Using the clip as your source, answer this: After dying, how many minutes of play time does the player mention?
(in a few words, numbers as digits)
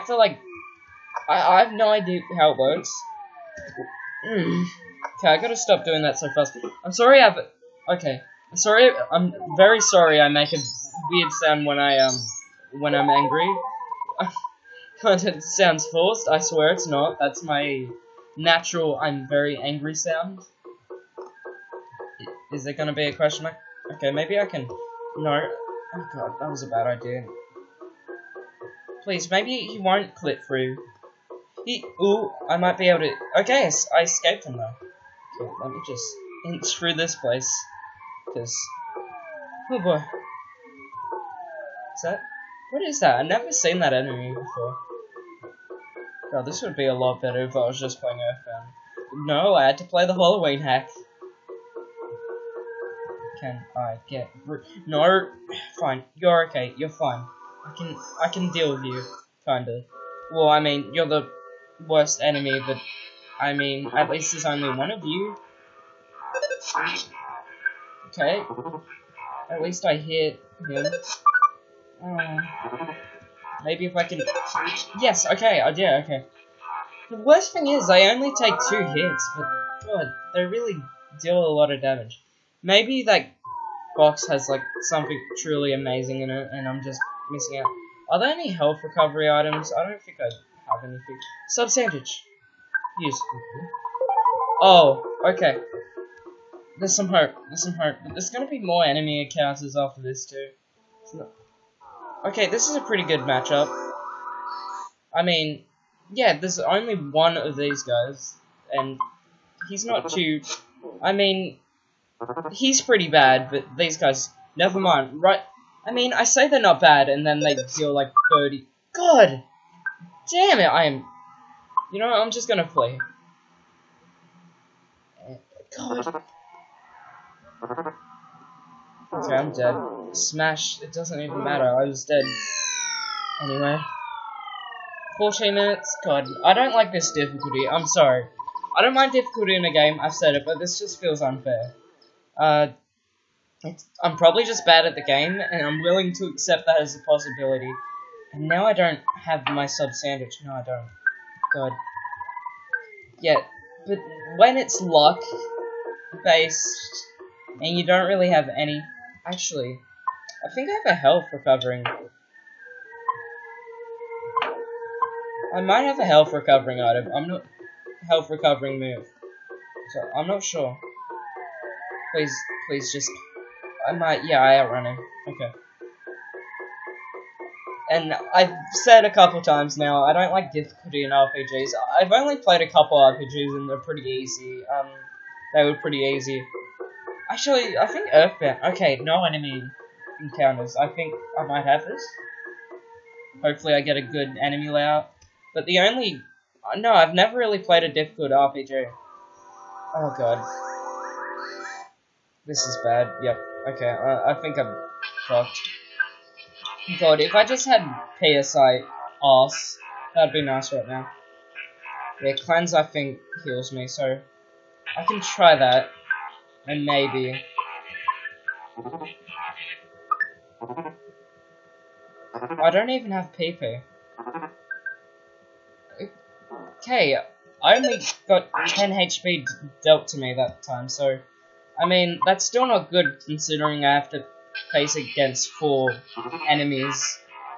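14.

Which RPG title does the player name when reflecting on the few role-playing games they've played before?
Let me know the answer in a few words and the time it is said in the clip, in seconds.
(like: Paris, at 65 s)
Earthbound, at 188 s.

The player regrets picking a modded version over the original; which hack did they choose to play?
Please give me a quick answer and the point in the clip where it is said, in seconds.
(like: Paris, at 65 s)
Halloween hack, at 50 s.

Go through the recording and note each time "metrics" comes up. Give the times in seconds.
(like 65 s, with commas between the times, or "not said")
not said.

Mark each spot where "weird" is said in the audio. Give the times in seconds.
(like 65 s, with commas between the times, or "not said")
11 s.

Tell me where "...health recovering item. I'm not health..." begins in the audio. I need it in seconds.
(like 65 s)
166 s.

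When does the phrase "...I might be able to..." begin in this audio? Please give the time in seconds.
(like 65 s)
32 s.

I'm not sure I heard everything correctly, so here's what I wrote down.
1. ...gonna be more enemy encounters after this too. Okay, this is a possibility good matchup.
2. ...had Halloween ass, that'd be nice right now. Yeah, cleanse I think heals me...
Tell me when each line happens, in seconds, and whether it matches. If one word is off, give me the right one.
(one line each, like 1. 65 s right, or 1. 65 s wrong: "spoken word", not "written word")
1. 98 s wrong: "pretty", not "possibility"
2. 207 s wrong: "PSI", not "Halloween".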